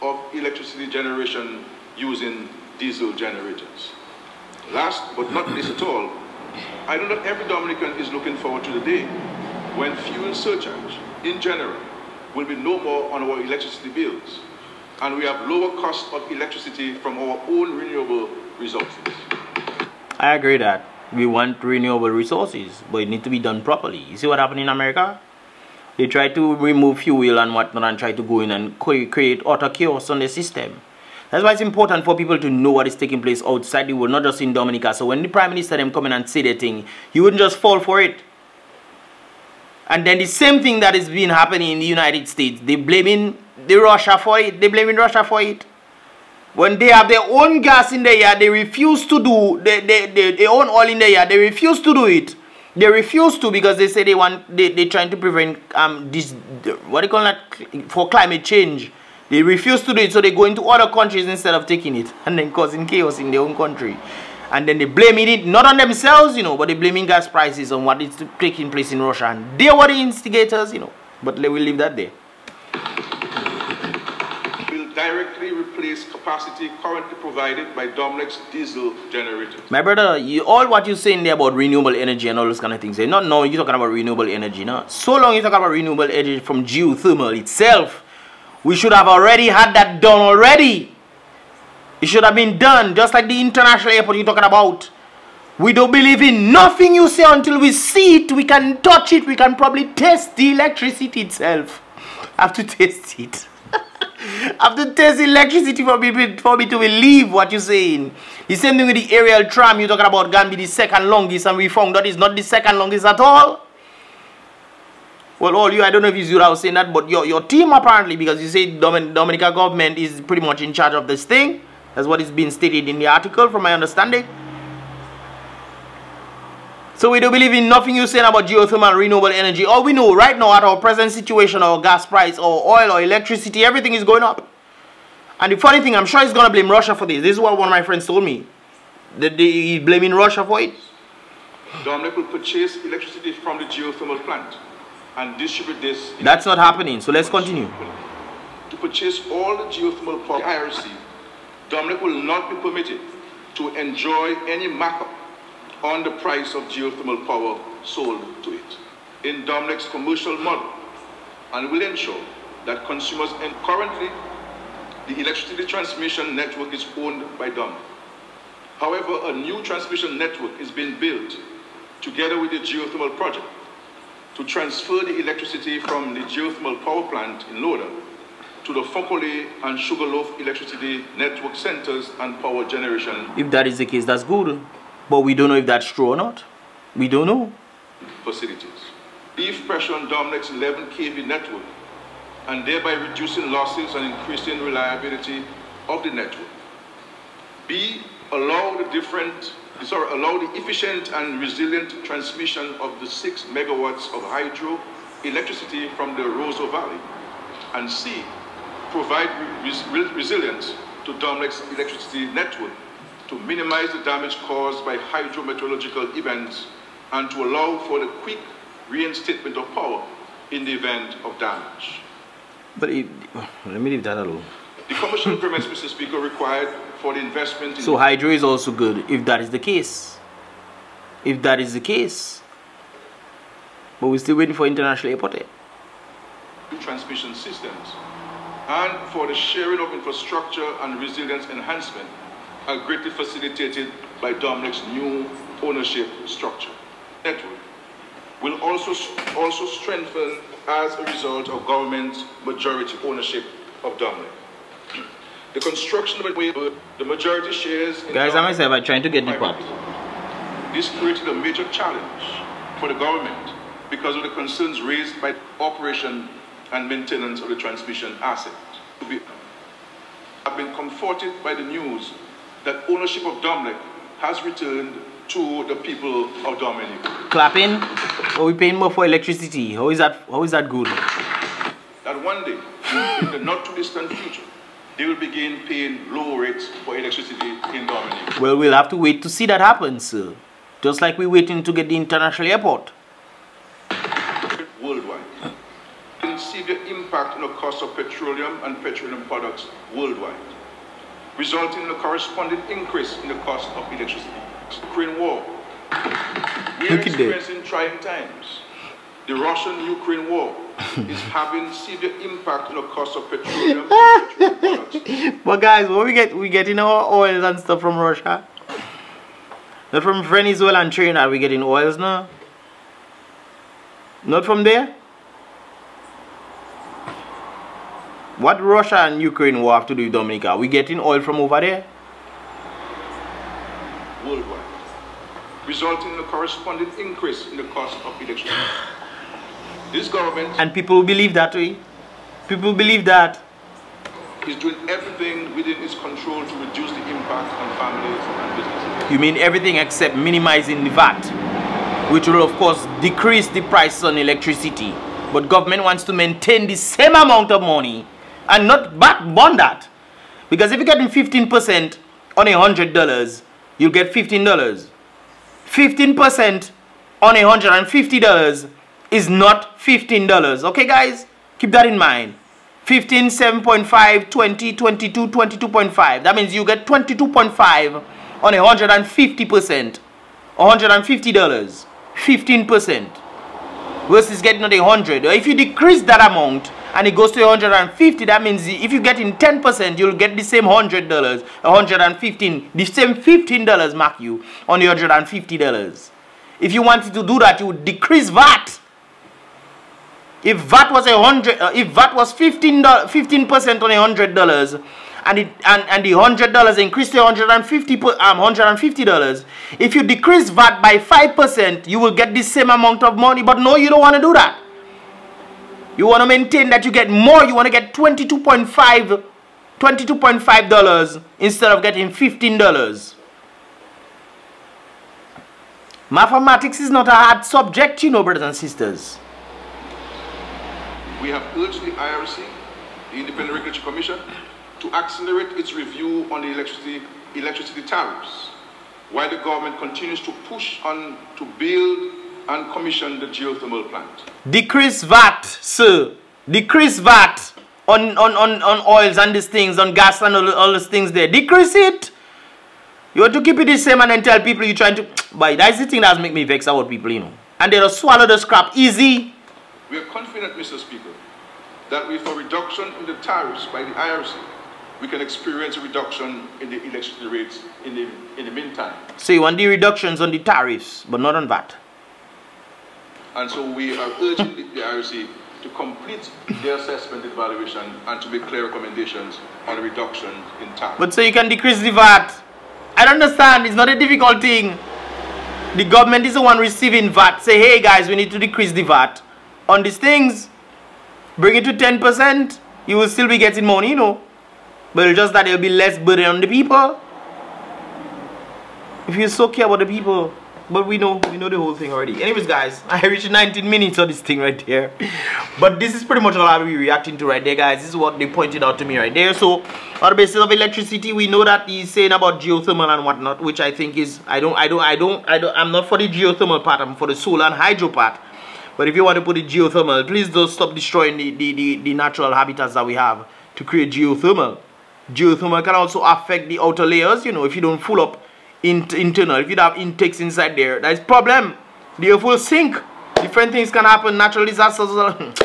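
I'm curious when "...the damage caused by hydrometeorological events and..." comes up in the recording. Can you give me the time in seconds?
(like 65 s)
213 s.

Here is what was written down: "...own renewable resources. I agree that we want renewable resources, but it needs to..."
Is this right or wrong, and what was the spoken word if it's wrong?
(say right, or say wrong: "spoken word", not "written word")
right.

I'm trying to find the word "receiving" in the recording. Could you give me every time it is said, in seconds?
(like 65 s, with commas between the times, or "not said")
486 s.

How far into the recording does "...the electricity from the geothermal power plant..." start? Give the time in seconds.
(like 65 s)
175 s.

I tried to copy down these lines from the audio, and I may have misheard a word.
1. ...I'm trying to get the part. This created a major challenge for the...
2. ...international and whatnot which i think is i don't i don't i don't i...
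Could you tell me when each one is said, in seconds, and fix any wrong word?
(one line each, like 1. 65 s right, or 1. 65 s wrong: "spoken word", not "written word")
1. 258 s right
2. 512 s wrong: "geothermal", not "international".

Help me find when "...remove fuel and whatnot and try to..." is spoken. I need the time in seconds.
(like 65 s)
26 s.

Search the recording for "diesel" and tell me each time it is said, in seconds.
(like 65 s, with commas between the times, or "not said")
2 s, 78 s.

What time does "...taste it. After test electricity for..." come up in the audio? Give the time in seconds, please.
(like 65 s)
102 s.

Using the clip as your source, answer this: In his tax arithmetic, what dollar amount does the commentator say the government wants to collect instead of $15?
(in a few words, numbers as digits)
$22.50.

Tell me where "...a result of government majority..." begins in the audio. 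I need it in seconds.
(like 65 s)
250 s.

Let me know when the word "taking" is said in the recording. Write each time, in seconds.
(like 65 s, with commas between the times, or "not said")
32 s, 61 s, 68 s.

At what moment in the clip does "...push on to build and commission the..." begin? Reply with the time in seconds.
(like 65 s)
440 s.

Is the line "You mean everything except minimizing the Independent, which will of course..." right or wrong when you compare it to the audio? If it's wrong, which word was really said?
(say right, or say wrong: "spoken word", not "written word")
wrong: "VAT", not "Independent".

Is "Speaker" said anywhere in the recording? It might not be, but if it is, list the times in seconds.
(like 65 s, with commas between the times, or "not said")
225 s, 460 s.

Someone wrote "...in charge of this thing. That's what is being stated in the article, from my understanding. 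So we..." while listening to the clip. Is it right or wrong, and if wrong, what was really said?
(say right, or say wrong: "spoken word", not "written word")
right.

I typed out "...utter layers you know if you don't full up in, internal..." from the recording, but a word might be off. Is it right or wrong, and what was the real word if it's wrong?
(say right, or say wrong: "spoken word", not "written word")
wrong: "outer", not "utter".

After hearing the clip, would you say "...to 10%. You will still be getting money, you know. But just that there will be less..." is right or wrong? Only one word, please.
right.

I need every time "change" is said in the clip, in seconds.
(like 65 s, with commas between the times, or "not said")
58 s.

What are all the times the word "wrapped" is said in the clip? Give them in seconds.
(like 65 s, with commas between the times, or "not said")
not said.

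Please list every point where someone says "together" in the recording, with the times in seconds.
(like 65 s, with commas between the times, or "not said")
172 s.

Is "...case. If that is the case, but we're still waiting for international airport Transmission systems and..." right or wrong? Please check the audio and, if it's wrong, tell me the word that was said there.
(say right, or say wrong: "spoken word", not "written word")
right.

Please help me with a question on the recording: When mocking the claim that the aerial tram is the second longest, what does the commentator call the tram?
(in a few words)
Gambi.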